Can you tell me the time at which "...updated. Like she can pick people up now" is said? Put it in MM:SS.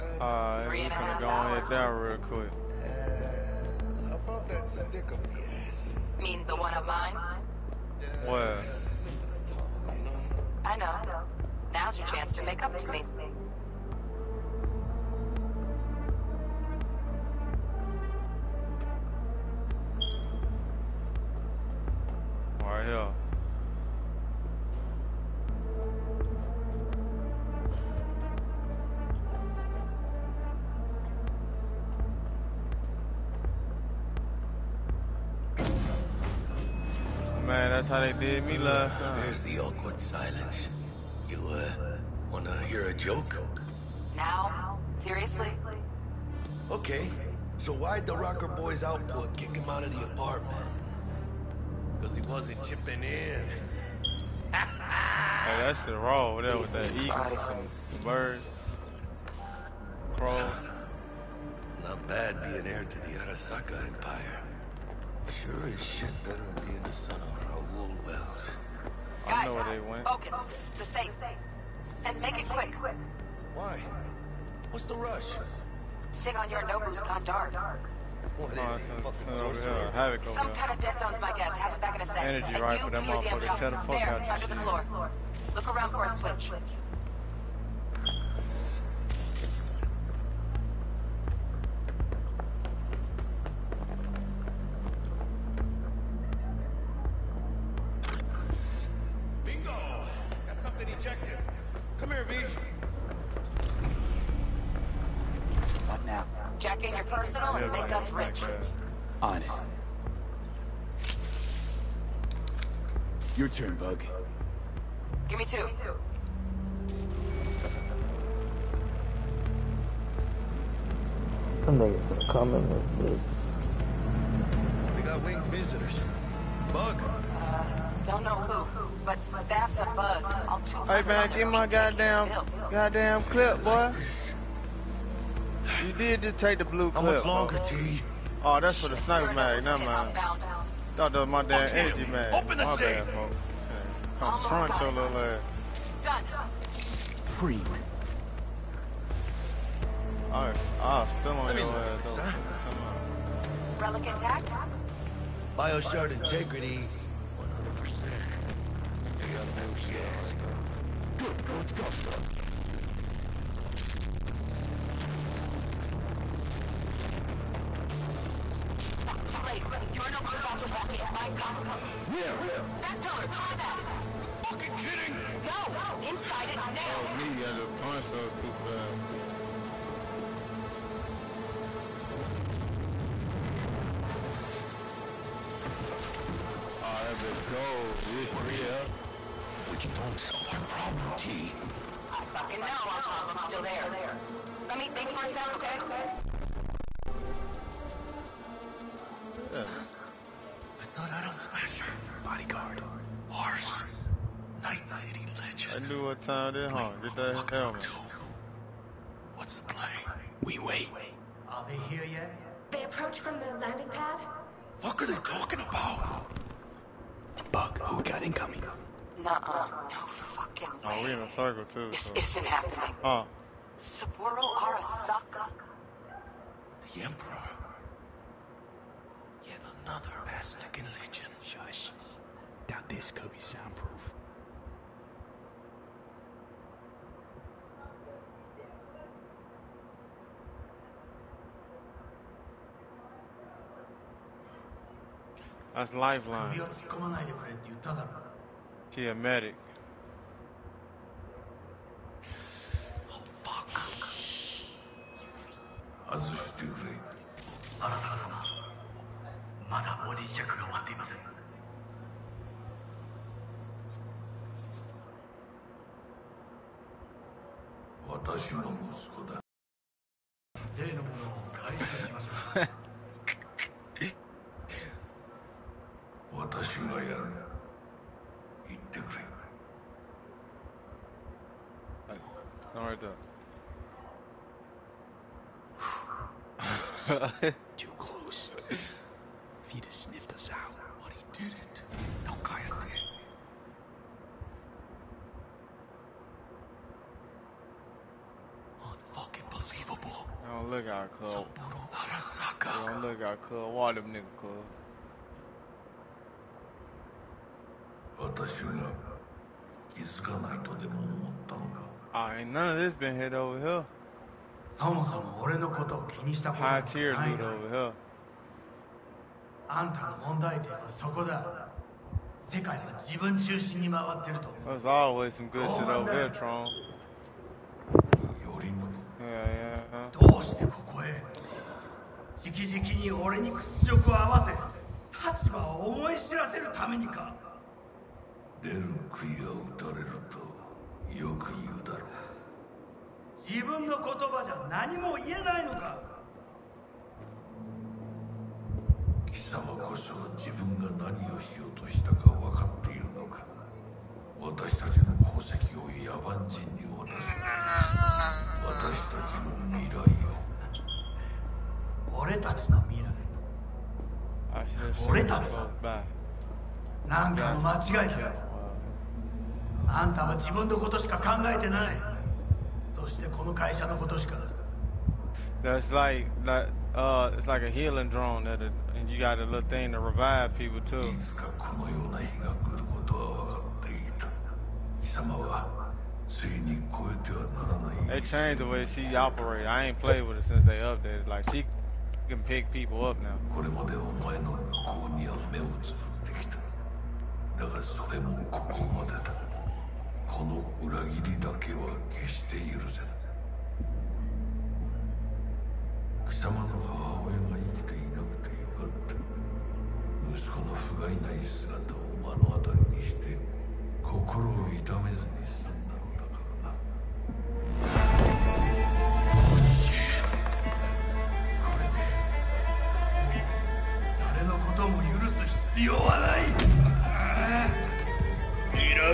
06:30.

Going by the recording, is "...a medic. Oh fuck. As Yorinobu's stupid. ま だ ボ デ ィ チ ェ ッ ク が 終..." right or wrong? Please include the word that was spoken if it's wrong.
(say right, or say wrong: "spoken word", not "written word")
wrong: "That", not "Yorinobu".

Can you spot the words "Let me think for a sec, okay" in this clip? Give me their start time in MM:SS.
03:14.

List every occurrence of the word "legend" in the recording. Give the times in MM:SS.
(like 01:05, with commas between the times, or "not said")
03:25, 03:50.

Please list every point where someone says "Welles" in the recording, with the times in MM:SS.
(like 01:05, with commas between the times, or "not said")
01:08.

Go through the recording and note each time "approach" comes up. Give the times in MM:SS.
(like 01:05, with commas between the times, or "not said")
03:32.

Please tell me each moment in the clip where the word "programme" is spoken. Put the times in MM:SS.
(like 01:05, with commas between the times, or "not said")
not said.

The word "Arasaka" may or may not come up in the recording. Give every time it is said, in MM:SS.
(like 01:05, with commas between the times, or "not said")
01:03, 03:44.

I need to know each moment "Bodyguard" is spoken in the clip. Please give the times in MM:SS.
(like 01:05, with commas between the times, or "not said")
03:22.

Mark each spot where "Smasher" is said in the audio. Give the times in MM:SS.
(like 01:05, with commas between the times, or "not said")
03:21.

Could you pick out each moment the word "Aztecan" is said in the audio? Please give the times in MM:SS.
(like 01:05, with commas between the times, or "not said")
03:50.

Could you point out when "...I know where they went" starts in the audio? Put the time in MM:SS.
01:09.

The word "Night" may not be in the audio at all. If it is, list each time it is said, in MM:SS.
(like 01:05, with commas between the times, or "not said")
03:24.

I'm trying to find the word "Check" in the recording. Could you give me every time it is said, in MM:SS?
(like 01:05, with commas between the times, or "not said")
01:46.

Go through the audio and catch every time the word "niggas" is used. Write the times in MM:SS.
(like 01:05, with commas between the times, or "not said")
02:01, 05:04.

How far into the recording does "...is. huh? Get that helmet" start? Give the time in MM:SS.
03:26.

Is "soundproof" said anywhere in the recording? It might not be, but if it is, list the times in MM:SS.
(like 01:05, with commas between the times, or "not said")
03:53.